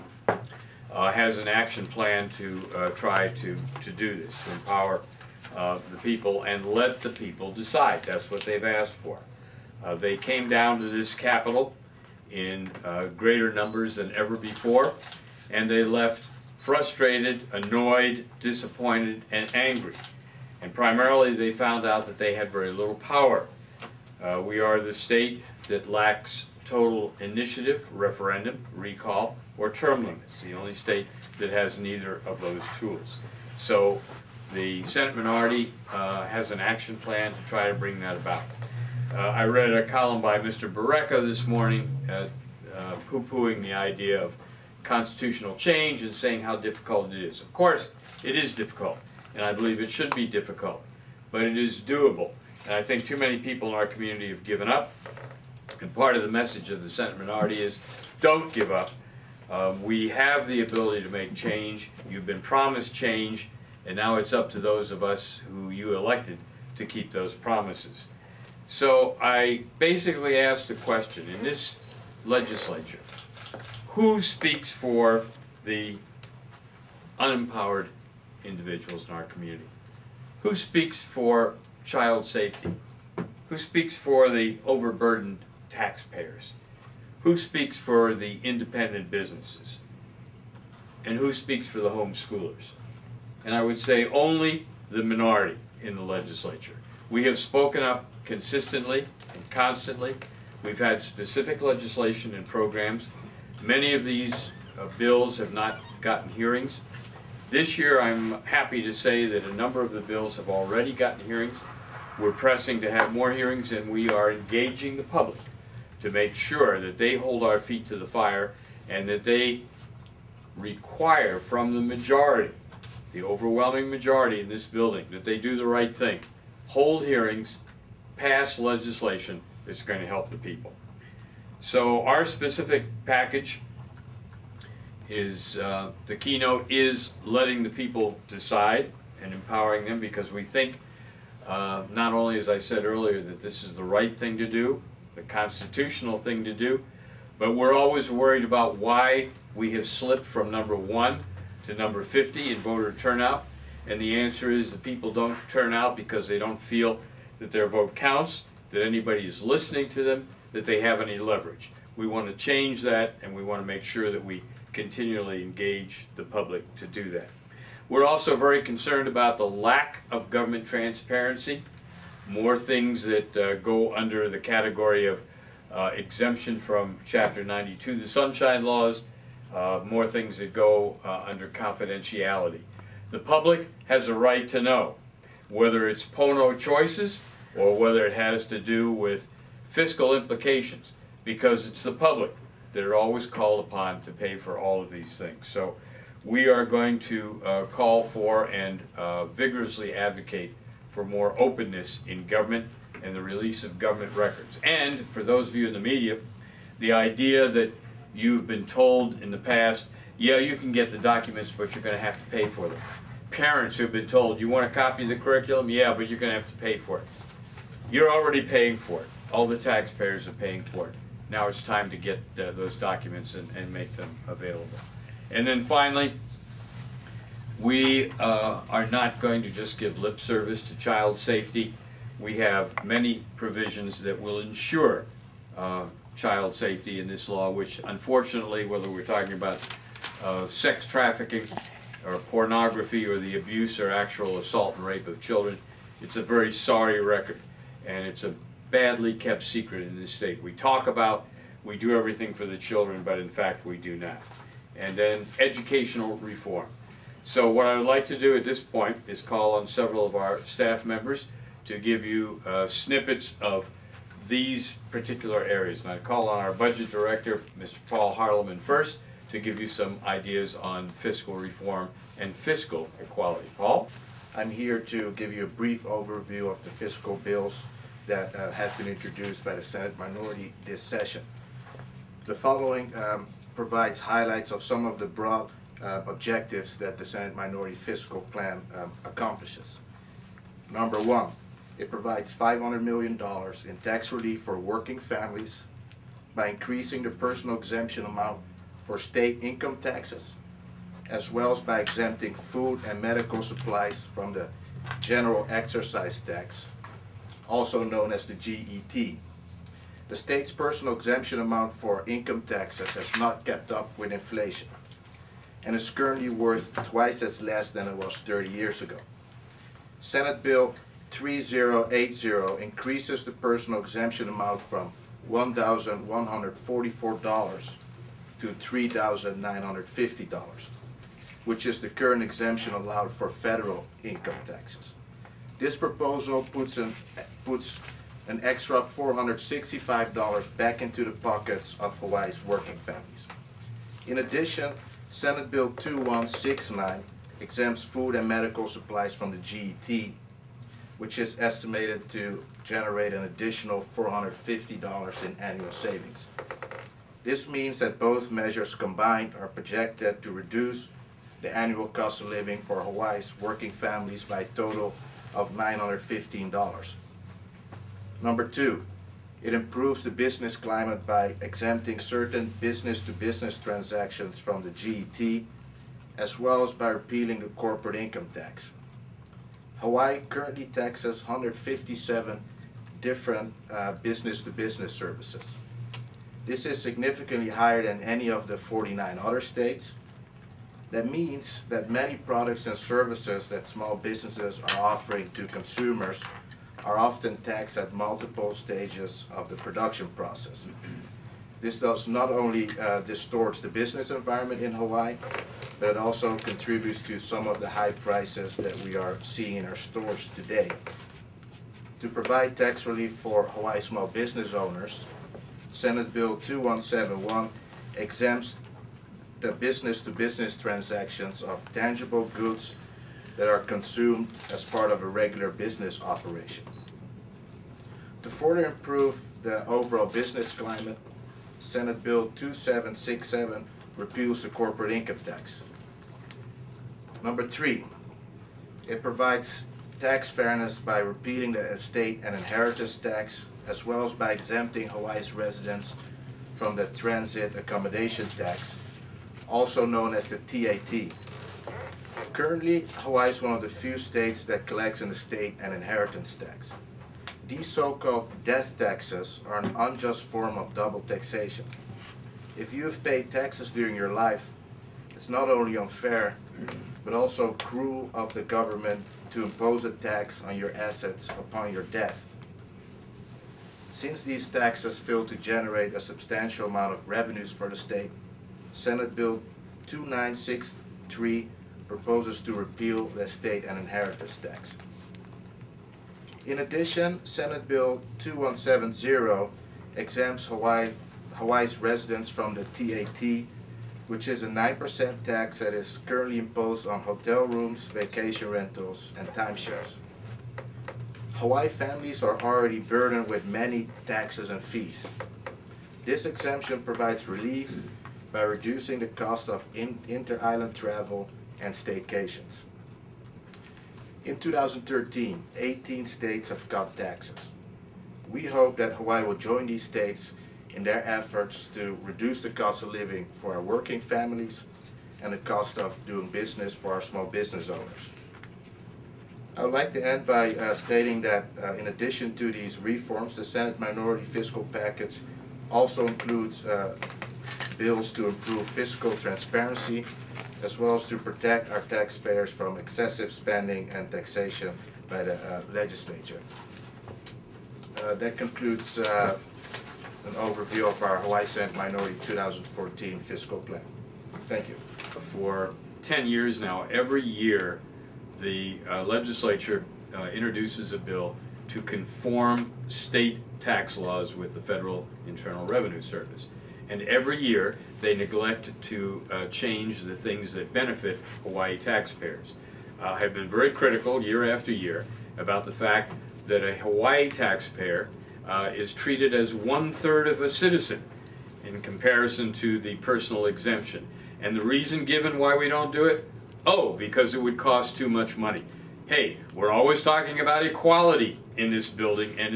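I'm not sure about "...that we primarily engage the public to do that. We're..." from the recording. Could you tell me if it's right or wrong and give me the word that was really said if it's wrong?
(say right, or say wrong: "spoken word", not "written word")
wrong: "continually", not "primarily".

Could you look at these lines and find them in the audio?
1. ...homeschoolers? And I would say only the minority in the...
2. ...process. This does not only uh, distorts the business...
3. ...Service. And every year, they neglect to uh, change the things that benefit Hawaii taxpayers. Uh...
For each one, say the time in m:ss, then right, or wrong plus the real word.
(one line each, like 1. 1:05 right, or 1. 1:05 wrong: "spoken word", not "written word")
1. 1:31 right
2. 6:40 right
3. 9:26 right.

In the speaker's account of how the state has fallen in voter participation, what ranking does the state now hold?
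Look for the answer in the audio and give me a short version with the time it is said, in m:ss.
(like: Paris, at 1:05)
number 50, at 2:31.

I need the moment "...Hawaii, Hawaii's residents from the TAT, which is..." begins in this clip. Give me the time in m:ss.
8:10.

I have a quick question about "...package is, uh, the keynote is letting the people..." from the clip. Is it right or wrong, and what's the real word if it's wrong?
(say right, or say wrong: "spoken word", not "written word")
right.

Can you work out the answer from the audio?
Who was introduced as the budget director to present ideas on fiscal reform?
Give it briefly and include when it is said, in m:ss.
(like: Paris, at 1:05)
Paul Harleman, at 4:27.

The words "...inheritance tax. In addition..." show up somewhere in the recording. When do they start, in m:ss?
8:03.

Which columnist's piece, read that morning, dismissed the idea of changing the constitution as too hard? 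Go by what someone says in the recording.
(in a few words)
Borreca.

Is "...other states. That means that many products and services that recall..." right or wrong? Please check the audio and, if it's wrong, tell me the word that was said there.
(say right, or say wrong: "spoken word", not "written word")
wrong: "small", not "recall".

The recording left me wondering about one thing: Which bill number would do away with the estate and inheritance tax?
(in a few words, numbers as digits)
Senate Bill 2963.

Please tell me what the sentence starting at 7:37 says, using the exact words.
These so-called death taxes are an unjust form of double taxation.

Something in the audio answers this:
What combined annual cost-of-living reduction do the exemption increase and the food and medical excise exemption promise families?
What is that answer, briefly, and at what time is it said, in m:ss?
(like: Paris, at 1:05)
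$915, at 6:05.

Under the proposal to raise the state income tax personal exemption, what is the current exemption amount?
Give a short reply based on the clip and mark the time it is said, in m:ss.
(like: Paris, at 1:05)
$1,144, at 5:25.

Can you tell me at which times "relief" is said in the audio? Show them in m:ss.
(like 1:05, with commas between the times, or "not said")
4:54, 6:52, 8:27.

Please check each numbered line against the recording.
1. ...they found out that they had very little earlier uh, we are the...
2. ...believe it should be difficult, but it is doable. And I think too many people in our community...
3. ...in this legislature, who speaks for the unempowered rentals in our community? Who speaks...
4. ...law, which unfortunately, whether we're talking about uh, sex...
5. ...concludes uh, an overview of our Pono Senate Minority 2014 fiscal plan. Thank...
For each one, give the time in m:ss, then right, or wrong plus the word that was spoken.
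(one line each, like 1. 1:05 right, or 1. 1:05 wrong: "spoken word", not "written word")
1. 0:21 wrong: "power", not "earlier"
2. 0:49 right
3. 1:11 wrong: "individuals", not "rentals"
4. 3:57 right
5. 9:08 wrong: "Hawaii", not "Pono".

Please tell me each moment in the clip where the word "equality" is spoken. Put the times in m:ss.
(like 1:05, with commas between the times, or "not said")
4:33, 9:50.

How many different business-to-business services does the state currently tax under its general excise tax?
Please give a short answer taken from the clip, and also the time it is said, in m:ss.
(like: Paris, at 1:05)
157, at 6:21.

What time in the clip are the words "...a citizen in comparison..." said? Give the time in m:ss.
9:40.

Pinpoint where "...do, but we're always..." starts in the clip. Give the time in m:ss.
2:26.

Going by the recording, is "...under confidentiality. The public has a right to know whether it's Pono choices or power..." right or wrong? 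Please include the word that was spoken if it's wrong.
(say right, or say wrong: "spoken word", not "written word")
wrong: "whether", not "power".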